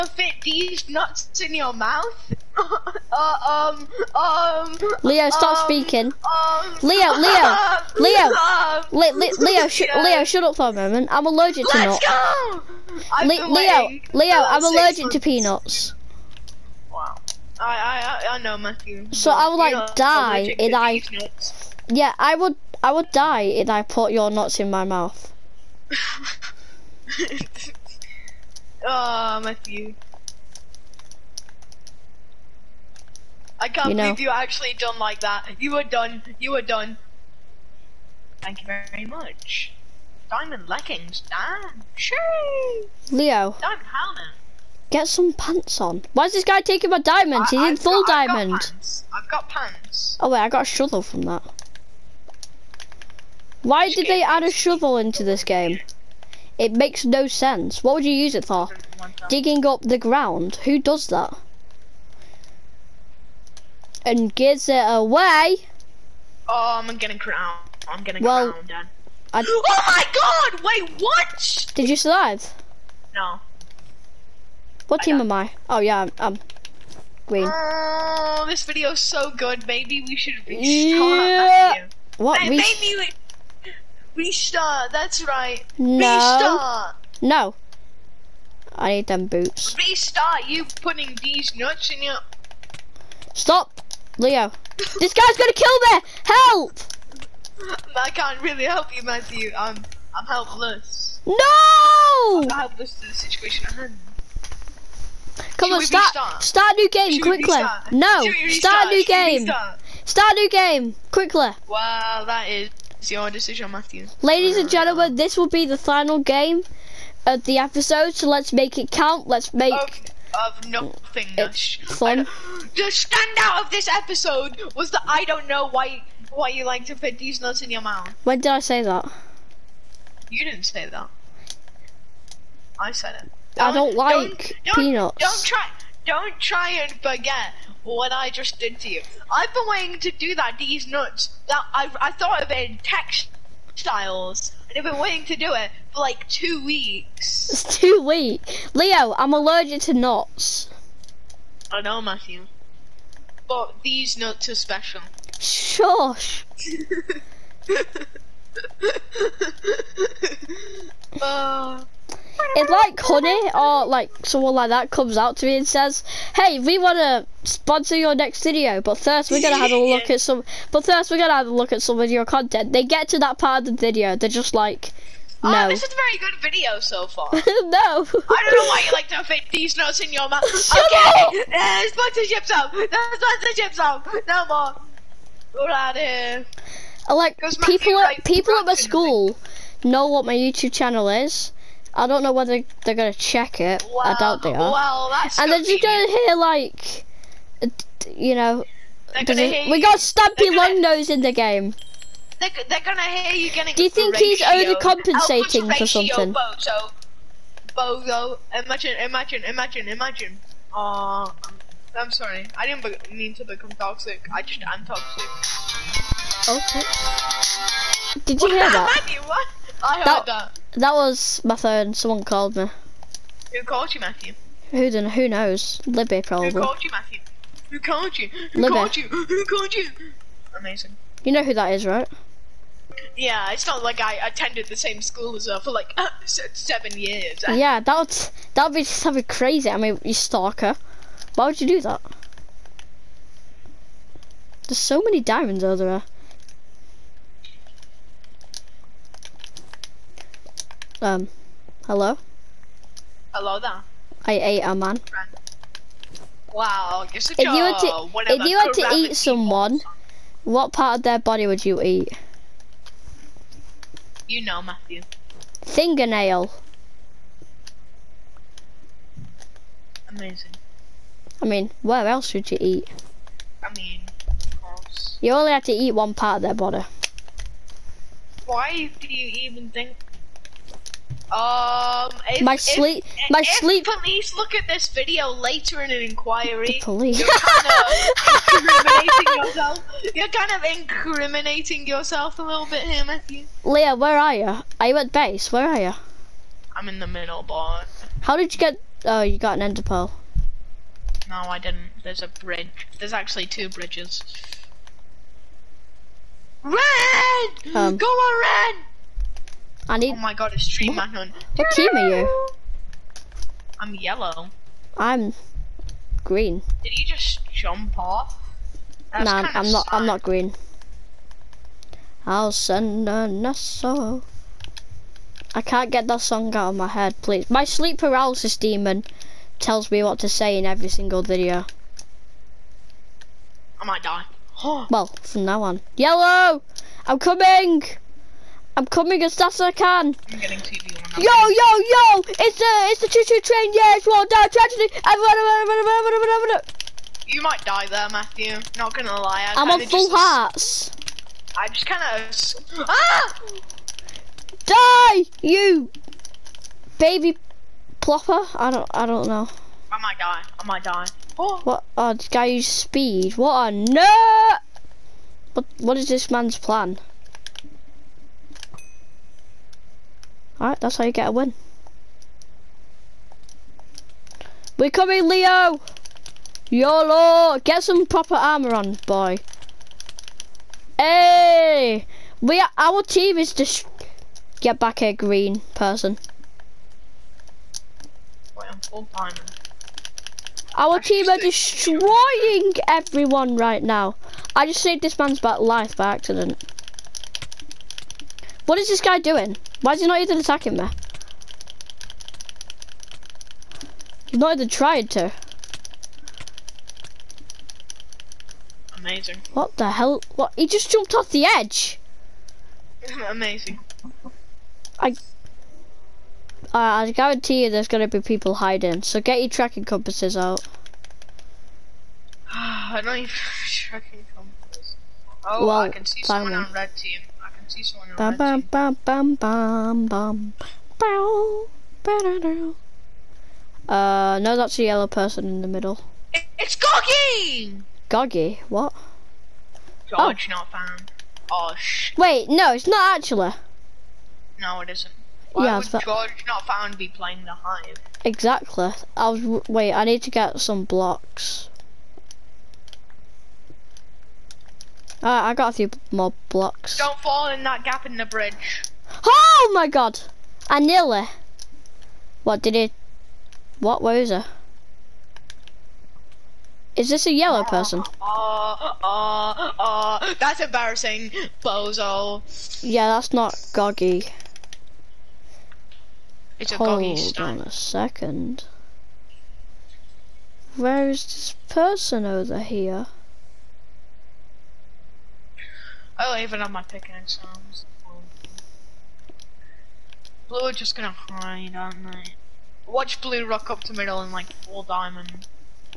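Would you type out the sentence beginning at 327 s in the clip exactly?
My sleep paralysis demon tells me what to say in every single video.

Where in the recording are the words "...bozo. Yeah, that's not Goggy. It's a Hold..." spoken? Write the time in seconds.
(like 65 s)
471 s.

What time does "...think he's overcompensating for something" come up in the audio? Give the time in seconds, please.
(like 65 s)
203 s.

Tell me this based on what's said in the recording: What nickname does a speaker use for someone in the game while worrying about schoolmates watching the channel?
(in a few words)
Stumpy Longnose.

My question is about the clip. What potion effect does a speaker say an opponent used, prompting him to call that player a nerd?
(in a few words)
Speed.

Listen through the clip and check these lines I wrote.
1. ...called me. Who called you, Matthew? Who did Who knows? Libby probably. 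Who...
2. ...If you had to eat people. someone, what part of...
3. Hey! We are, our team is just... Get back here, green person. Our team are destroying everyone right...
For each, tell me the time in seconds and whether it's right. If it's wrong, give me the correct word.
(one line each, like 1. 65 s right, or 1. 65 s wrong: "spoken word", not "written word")
1. 222 s right
2. 258 s right
3. 380 s right.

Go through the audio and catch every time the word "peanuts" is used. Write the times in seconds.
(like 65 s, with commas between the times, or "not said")
15 s, 134 s.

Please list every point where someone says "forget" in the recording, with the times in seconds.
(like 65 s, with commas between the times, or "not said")
137 s.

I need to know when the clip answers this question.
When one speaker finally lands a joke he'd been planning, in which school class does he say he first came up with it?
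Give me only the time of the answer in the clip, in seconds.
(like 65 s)
142 s.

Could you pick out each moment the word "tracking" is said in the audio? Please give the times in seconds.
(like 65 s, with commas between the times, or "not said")
419 s, 423 s.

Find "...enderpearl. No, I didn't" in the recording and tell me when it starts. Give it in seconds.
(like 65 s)
299 s.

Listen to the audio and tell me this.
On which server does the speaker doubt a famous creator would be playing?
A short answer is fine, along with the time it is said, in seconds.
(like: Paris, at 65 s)
The Hive, at 447 s.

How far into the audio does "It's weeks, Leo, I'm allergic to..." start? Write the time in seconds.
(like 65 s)
147 s.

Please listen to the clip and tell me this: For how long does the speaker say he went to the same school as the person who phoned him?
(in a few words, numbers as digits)
7 years.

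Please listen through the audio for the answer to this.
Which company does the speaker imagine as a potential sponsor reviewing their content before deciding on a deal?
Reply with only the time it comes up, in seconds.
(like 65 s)
163 s.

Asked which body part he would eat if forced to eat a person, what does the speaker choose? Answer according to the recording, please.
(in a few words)
Fingernail.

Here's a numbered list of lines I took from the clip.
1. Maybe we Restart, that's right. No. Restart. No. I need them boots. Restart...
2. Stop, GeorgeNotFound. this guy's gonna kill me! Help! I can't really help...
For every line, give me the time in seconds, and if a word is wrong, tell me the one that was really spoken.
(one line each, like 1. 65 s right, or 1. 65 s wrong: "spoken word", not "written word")
1. 82 s right
2. 93 s wrong: "Leo", not "GeorgeNotFound".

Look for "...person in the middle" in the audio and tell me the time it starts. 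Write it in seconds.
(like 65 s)
435 s.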